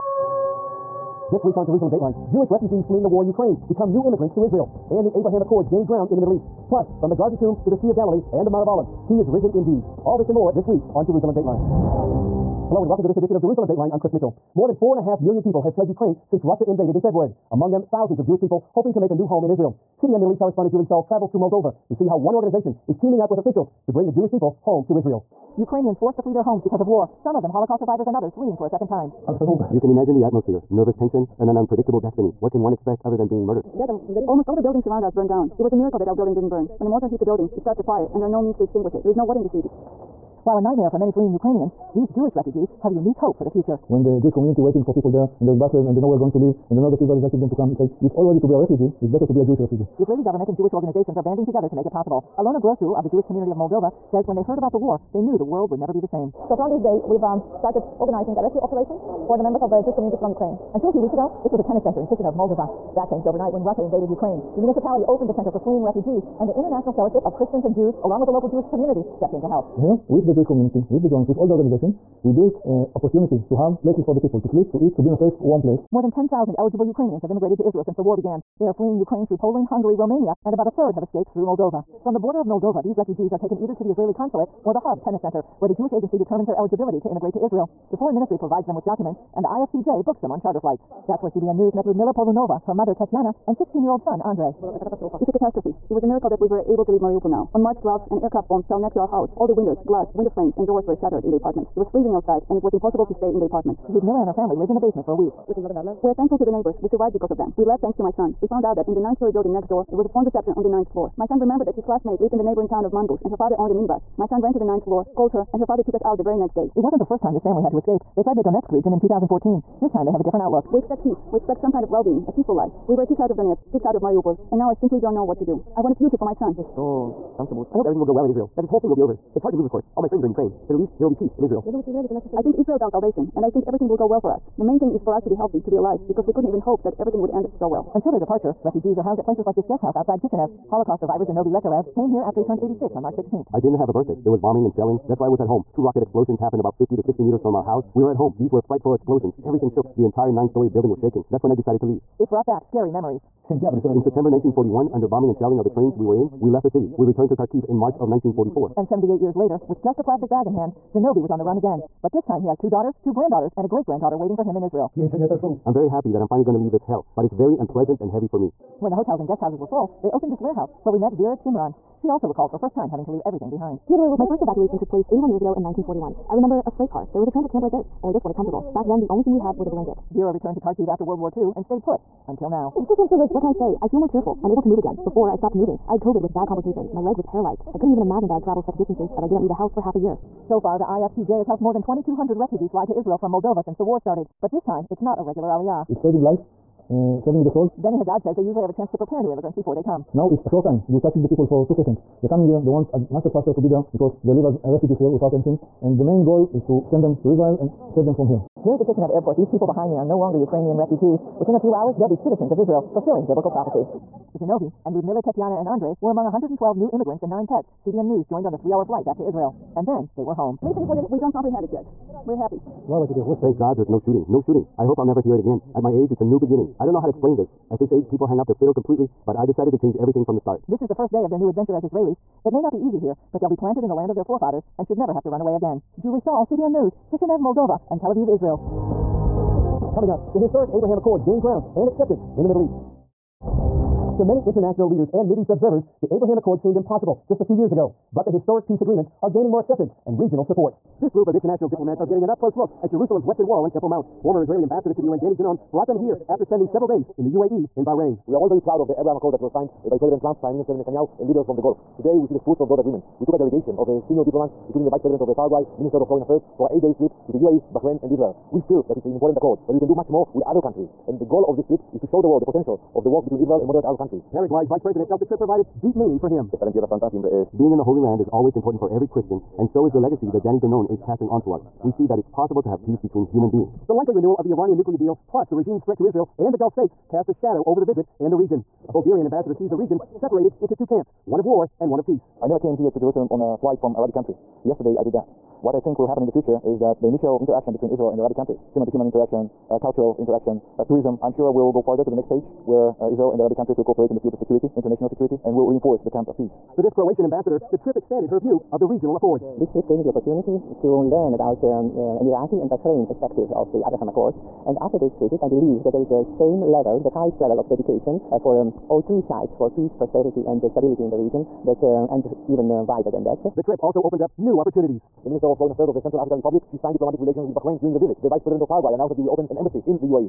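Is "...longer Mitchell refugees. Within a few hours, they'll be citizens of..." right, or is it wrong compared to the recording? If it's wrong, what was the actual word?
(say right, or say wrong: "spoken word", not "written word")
wrong: "Ukrainian", not "Mitchell".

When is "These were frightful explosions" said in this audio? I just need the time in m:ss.
2:28.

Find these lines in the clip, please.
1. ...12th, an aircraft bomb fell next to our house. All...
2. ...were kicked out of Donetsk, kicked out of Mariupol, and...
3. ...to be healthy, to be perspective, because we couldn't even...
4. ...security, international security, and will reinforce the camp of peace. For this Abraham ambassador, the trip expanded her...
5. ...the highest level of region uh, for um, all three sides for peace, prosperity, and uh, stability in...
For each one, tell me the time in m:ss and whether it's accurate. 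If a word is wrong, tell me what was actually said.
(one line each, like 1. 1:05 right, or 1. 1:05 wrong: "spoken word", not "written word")
1. 1:37 right
2. 2:02 right
3. 2:15 wrong: "alive", not "perspective"
4. 5:04 wrong: "Croatian", not "Abraham"
5. 5:16 wrong: "dedication", not "region".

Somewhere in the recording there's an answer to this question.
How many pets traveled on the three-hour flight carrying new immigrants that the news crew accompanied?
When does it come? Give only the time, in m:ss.
3:37.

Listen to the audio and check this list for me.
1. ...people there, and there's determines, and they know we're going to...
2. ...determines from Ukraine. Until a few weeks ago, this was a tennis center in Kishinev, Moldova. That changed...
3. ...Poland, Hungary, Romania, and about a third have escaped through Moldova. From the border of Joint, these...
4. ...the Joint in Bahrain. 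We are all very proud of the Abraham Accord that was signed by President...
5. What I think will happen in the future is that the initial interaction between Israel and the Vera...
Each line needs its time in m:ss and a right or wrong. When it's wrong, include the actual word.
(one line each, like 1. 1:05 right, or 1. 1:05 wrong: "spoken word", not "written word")
1. 0:44 wrong: "buses", not "determines"
2. 0:59 wrong: "communities", not "determines"
3. 1:19 wrong: "Moldova", not "Joint"
4. 4:17 wrong: "UAE", not "Joint"
5. 4:55 wrong: "Arabic", not "Vera".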